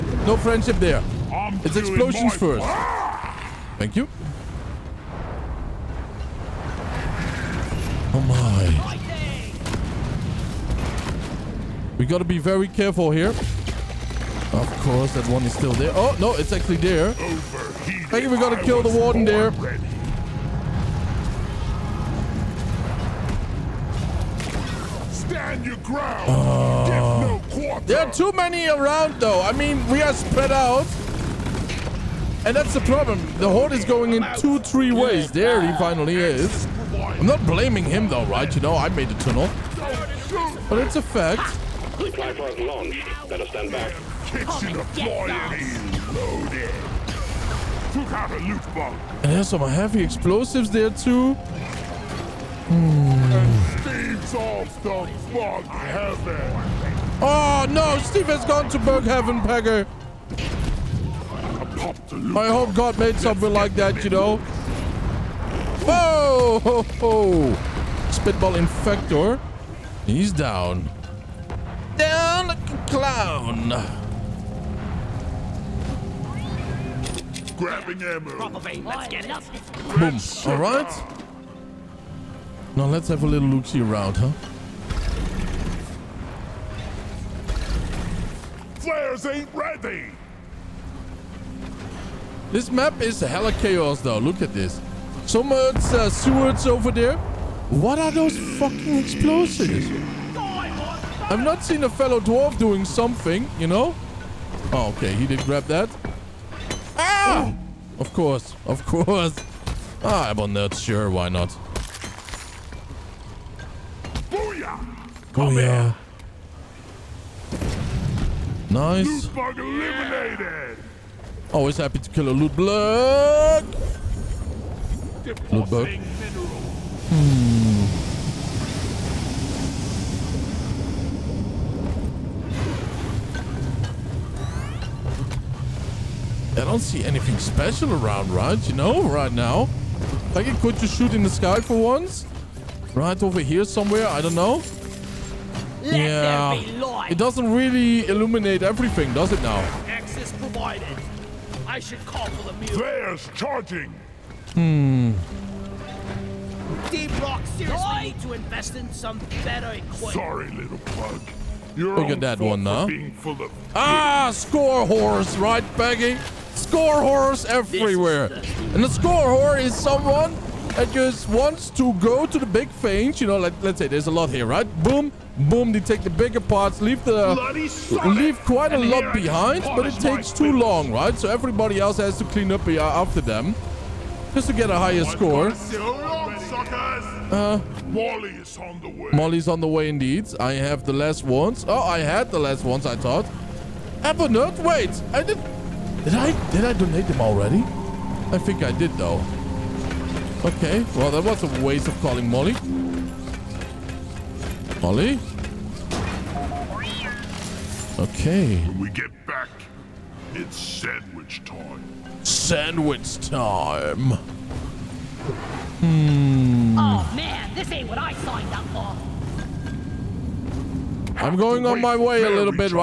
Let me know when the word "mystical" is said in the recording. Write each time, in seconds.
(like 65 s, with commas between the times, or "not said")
not said.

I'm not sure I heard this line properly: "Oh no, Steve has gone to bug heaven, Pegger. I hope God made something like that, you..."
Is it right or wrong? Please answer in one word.
right.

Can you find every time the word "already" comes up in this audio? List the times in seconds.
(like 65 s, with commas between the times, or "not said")
197 s.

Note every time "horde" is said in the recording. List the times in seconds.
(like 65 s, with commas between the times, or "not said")
33 s.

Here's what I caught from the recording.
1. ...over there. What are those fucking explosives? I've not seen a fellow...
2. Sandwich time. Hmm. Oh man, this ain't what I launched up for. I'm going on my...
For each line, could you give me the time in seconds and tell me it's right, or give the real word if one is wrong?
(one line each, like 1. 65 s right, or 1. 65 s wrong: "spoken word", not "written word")
1. 96 s right
2. 212 s wrong: "signed", not "launched".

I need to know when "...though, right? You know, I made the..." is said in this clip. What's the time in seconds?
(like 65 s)
38 s.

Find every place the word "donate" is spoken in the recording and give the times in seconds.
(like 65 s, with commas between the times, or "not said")
196 s.